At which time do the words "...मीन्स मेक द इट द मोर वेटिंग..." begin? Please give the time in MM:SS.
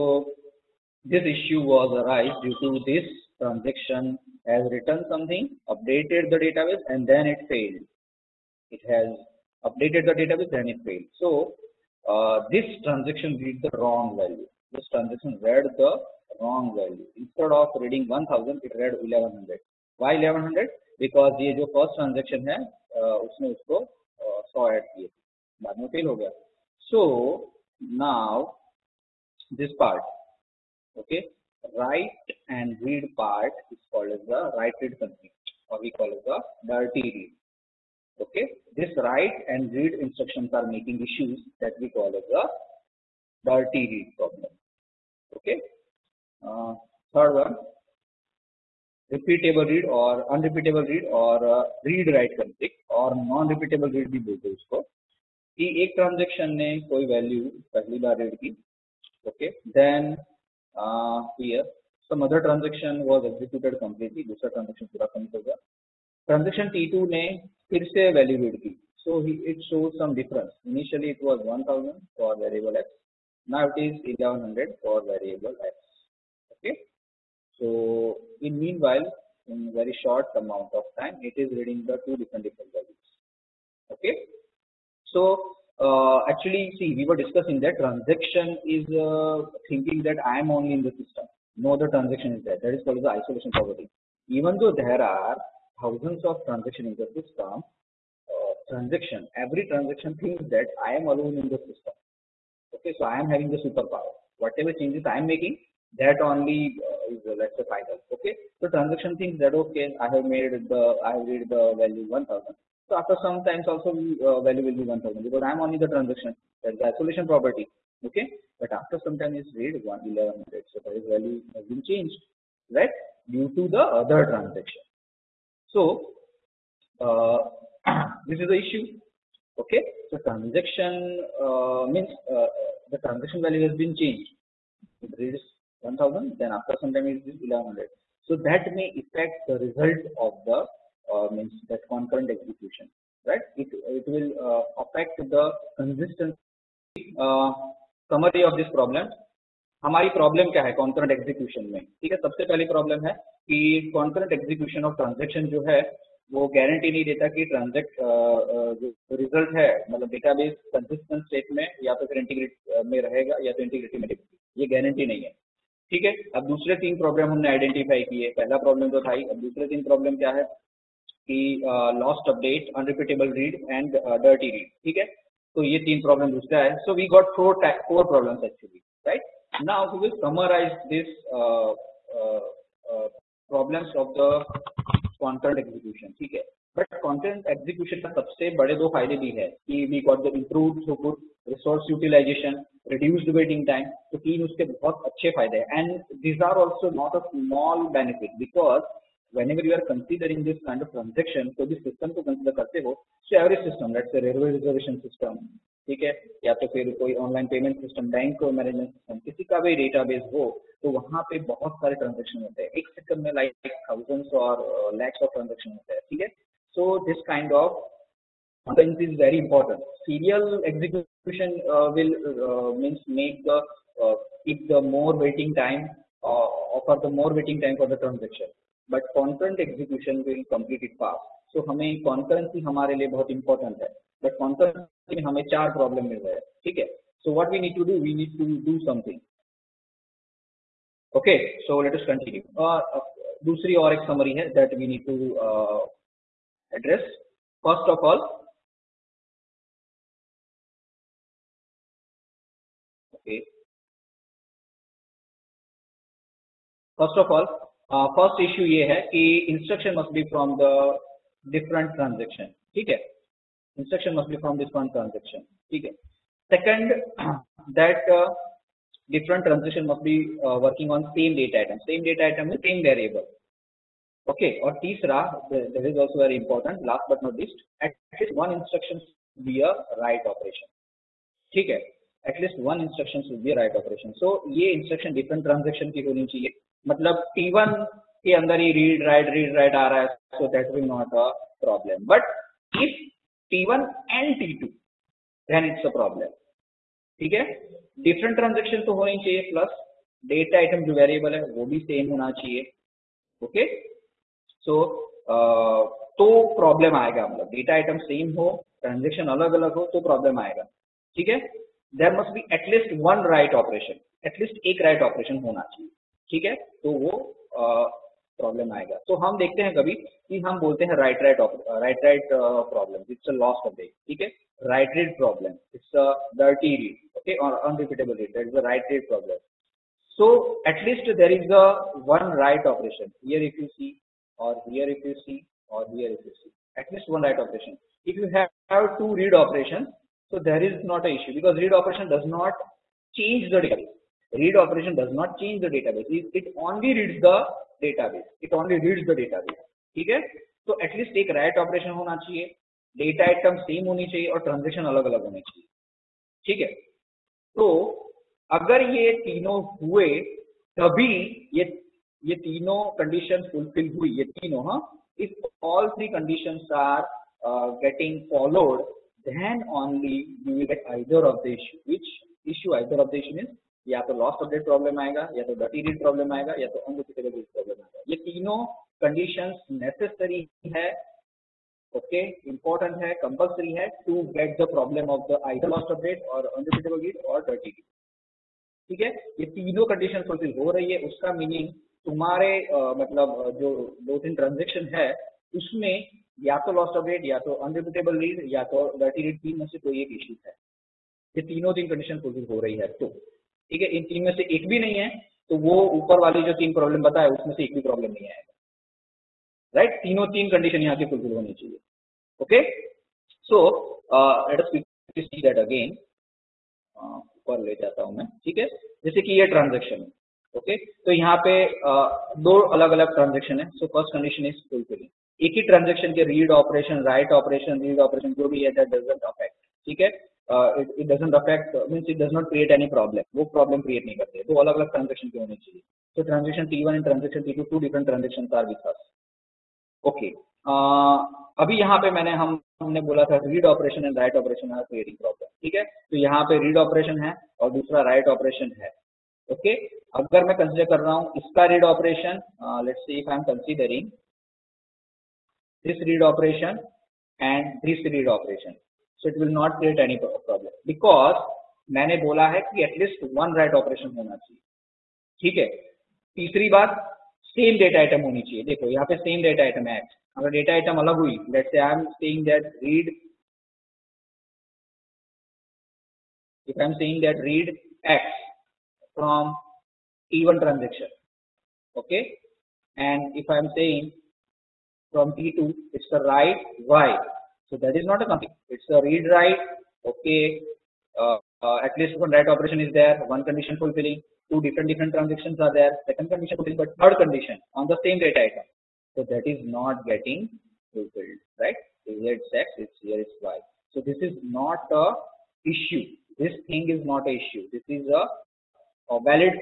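03:42.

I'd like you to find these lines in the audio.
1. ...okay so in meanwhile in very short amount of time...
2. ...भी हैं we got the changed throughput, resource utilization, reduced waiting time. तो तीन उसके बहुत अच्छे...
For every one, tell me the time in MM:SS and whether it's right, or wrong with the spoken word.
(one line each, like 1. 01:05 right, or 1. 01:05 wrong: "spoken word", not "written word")
1. 01:16 right
2. 03:09 wrong: "improved", not "changed".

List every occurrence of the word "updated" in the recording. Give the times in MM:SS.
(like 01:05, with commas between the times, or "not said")
00:05, 00:09.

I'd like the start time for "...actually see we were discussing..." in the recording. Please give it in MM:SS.
01:26.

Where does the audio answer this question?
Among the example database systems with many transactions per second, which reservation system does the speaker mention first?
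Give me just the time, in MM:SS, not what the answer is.
03:24.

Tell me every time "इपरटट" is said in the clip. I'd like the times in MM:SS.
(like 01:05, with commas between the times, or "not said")
03:39, 03:53, 06:22.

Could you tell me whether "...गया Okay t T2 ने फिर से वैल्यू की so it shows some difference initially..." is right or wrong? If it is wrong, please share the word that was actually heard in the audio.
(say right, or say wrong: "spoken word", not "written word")
wrong: "Transaction", not "Okay".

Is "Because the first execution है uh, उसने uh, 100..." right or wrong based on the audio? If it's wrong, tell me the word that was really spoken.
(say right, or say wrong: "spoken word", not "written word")
wrong: "transaction", not "execution".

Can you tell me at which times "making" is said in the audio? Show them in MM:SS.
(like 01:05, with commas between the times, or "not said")
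00:40, 01:45.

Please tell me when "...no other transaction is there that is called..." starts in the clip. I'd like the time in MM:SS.
01:31.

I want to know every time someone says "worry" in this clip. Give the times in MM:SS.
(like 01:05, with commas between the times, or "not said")
not said.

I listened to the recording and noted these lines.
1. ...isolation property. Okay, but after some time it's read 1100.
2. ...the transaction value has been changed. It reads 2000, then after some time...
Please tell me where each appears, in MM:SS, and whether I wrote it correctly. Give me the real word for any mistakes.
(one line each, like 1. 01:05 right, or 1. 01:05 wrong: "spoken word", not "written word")
1. 01:56 right
2. 02:12 wrong: "1000", not "2000".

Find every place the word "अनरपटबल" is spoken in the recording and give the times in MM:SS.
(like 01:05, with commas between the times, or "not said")
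02:52, 05:27, 06:37.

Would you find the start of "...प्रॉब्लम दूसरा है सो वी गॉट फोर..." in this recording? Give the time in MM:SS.
02:56.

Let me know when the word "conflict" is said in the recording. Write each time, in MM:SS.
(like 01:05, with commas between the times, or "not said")
00:34, 00:52, 08:08.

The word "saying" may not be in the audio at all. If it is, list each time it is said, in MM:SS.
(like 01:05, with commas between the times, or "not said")
07:56, 08:03.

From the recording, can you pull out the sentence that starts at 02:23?
It it will uh, affect the consistency.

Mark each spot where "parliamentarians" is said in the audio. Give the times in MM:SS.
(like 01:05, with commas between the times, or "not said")
not said.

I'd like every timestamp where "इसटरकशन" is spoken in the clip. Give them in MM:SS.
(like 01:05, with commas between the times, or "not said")
04:19.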